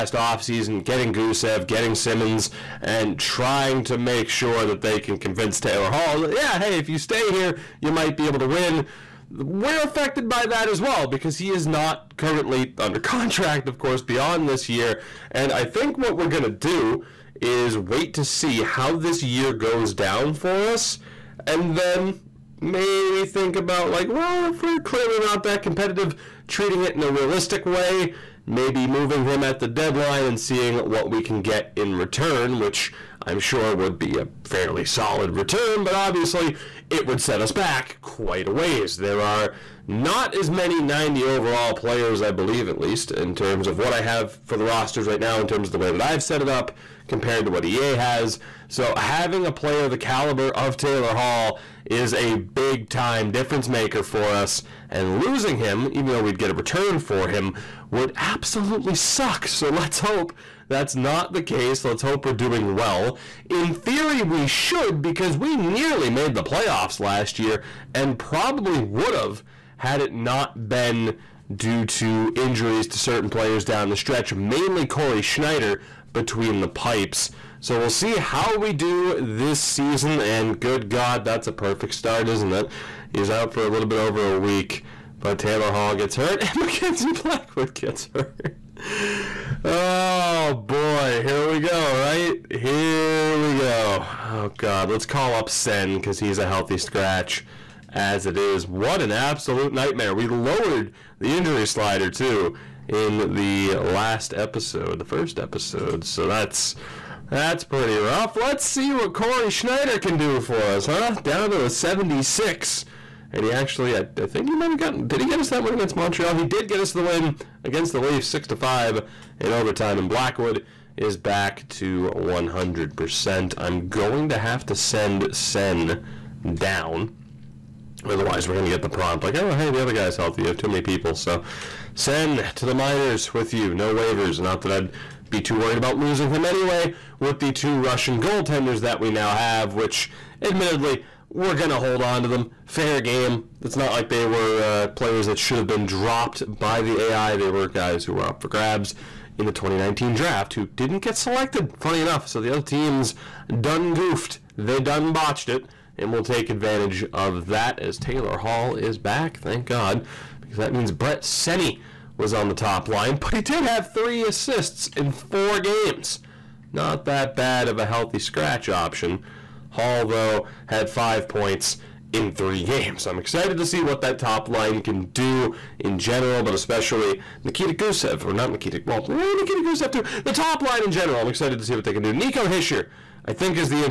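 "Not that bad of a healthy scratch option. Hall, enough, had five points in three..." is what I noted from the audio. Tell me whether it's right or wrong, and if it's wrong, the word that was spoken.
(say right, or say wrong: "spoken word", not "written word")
wrong: "though", not "enough".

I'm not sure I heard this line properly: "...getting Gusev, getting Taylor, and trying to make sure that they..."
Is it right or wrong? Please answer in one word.
wrong.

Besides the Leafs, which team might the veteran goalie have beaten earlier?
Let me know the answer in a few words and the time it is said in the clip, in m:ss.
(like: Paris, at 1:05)
Montreal, at 1:55.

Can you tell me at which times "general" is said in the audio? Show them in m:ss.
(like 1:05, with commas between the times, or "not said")
2:55, 3:00.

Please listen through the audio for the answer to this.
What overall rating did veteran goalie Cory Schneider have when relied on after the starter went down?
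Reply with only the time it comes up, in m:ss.
1:51.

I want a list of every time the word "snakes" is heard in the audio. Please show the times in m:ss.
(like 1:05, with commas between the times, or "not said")
not said.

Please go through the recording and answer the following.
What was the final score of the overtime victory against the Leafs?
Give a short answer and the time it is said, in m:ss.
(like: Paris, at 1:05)
6-5, at 1:58.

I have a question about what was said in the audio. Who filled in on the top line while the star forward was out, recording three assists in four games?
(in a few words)
Brett Seney.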